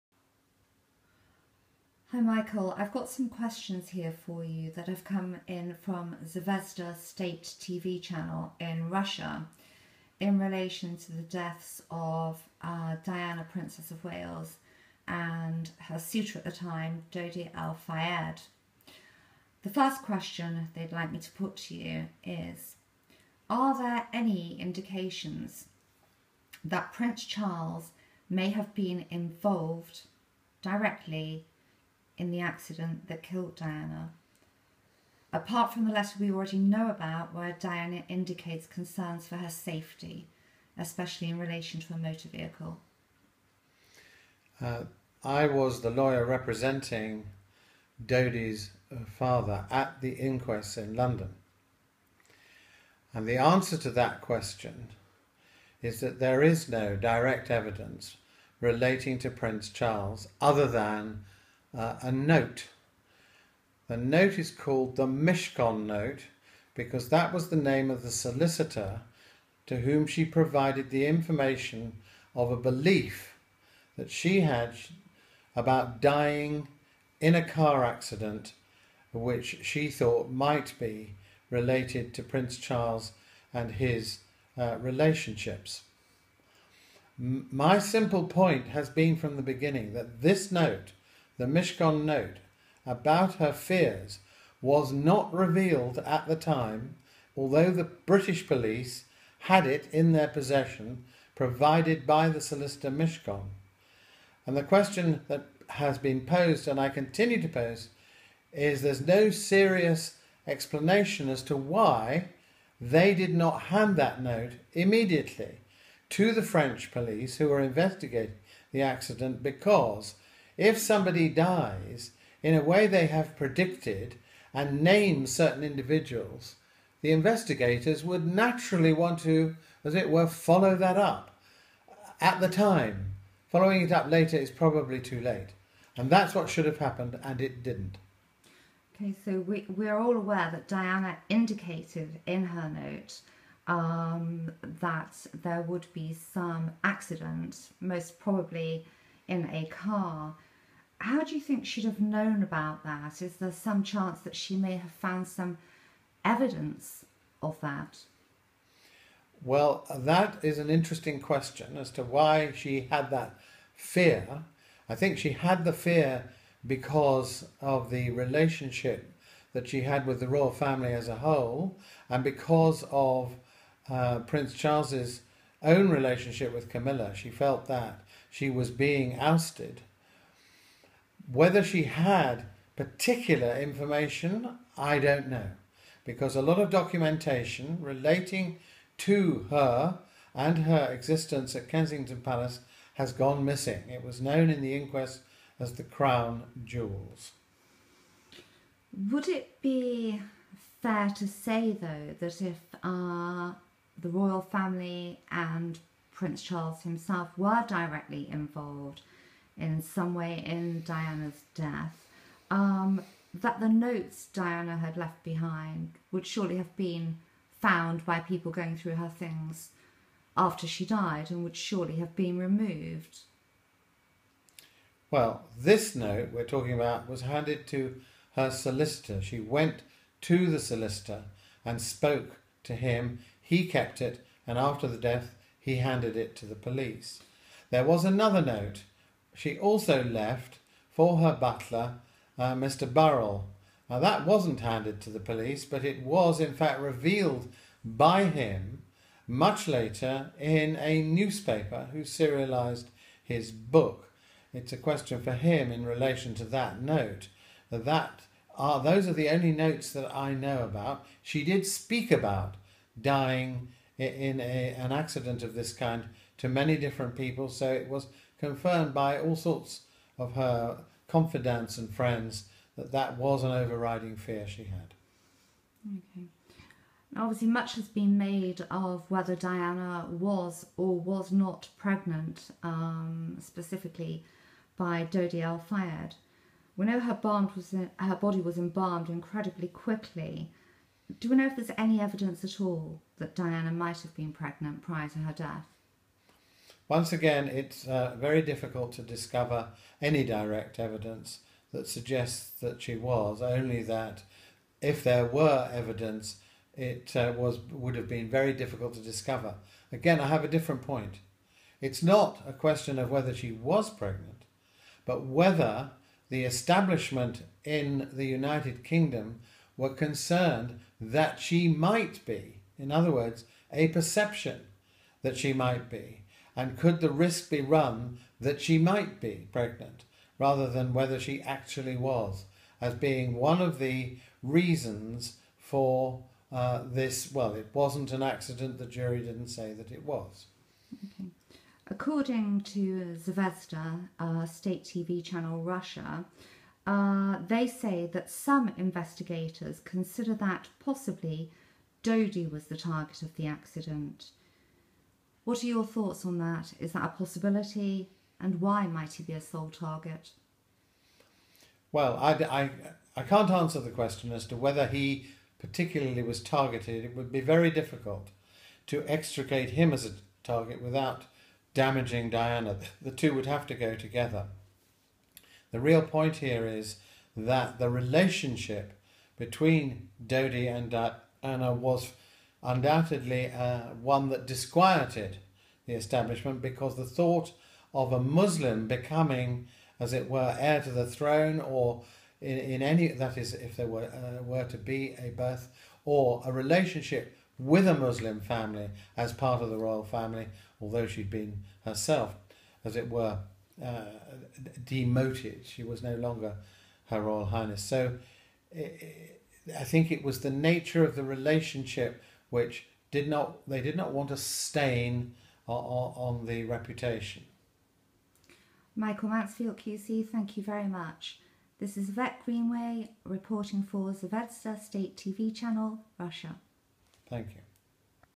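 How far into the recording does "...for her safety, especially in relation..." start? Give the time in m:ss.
0:39.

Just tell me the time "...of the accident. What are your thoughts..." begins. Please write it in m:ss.
5:53.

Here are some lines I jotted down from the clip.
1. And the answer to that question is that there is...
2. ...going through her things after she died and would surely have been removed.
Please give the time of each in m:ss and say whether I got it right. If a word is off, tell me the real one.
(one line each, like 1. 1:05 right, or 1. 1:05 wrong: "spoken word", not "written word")
1. 0:53 right
2. 3:38 right.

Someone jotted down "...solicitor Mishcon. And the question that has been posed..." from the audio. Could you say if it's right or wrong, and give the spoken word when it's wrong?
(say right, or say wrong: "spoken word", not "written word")
right.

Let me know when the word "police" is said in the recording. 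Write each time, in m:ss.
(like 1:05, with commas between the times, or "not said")
1:38, 1:56, 3:56, 4:05.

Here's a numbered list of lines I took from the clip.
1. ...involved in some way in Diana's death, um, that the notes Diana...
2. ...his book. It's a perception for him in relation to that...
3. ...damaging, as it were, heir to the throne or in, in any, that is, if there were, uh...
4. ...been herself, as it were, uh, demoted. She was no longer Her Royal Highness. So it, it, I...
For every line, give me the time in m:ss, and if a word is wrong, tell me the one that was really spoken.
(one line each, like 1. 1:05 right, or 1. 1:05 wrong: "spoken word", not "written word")
1. 3:28 right
2. 4:13 wrong: "question", not "perception"
3. 6:28 wrong: "becoming", not "damaging"
4. 6:41 right.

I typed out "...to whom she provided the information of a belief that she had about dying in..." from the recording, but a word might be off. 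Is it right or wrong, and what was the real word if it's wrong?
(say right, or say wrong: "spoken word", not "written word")
right.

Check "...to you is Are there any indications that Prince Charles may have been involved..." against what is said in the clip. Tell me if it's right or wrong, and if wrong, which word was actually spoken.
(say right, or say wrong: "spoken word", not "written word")
right.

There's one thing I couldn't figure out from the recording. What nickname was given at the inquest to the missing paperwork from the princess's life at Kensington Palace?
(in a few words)
the Crown Jewels.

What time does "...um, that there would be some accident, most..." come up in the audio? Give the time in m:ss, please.
2:23.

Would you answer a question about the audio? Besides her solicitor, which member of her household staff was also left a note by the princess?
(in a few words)
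Mr. Burrell.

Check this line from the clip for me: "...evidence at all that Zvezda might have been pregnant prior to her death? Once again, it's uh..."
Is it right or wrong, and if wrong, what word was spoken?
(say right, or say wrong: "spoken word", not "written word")
wrong: "Diana", not "Zvezda".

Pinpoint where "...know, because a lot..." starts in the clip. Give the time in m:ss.
3:05.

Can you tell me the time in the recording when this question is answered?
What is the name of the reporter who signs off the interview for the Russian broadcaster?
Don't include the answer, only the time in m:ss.
7:02.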